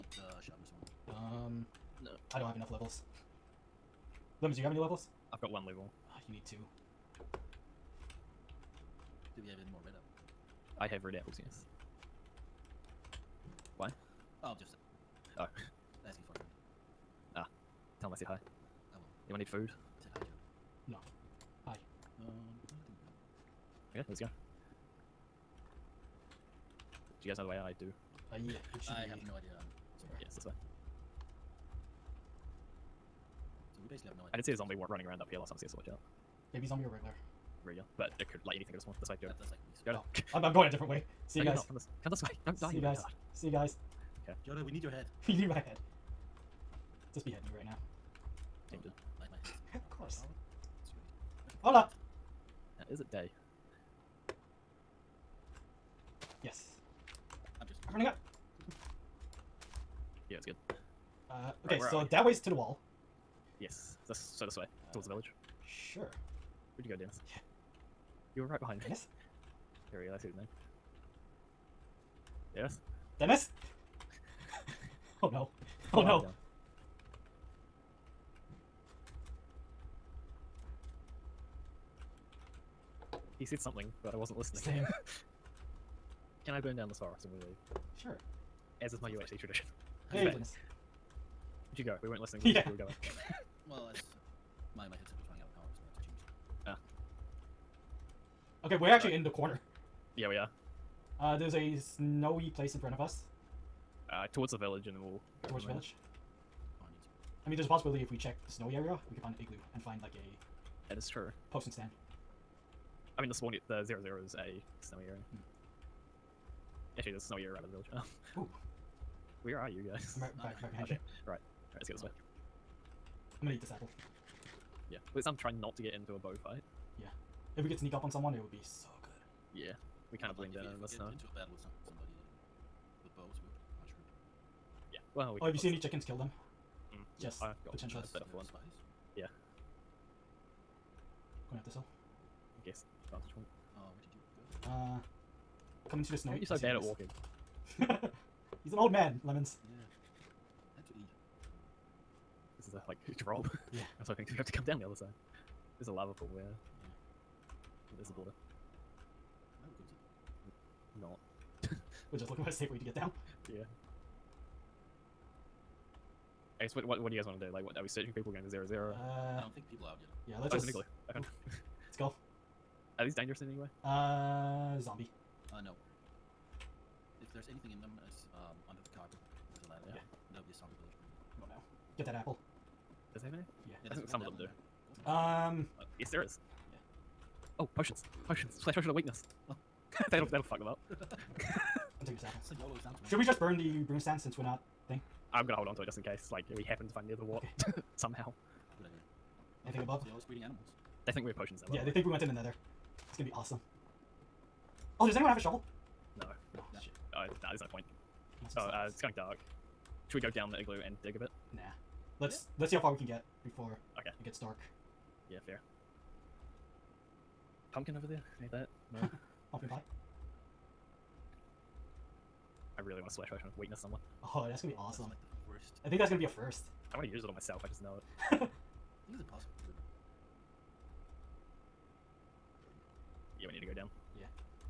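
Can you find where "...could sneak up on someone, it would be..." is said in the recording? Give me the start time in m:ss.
2:07.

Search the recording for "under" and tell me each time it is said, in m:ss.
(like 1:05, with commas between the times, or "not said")
2:58.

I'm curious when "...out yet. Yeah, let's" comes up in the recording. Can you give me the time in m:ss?
2:49.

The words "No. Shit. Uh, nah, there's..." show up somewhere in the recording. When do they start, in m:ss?
3:26.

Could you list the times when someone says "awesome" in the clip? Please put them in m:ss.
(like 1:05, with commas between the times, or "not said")
3:23, 3:44.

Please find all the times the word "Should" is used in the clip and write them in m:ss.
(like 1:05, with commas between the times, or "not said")
3:13, 3:30.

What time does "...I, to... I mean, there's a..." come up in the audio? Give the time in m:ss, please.
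1:46.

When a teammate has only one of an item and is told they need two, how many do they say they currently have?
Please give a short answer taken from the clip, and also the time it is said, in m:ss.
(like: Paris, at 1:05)
1, at 0:05.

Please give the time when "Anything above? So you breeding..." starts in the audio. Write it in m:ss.
3:19.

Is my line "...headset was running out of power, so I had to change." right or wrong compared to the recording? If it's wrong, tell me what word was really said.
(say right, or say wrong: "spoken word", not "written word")
right.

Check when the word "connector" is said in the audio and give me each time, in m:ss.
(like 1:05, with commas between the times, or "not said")
not said.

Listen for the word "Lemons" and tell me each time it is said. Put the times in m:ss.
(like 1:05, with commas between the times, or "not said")
0:04, 2:29.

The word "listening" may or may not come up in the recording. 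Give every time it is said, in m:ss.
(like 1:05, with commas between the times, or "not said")
1:24, 1:32.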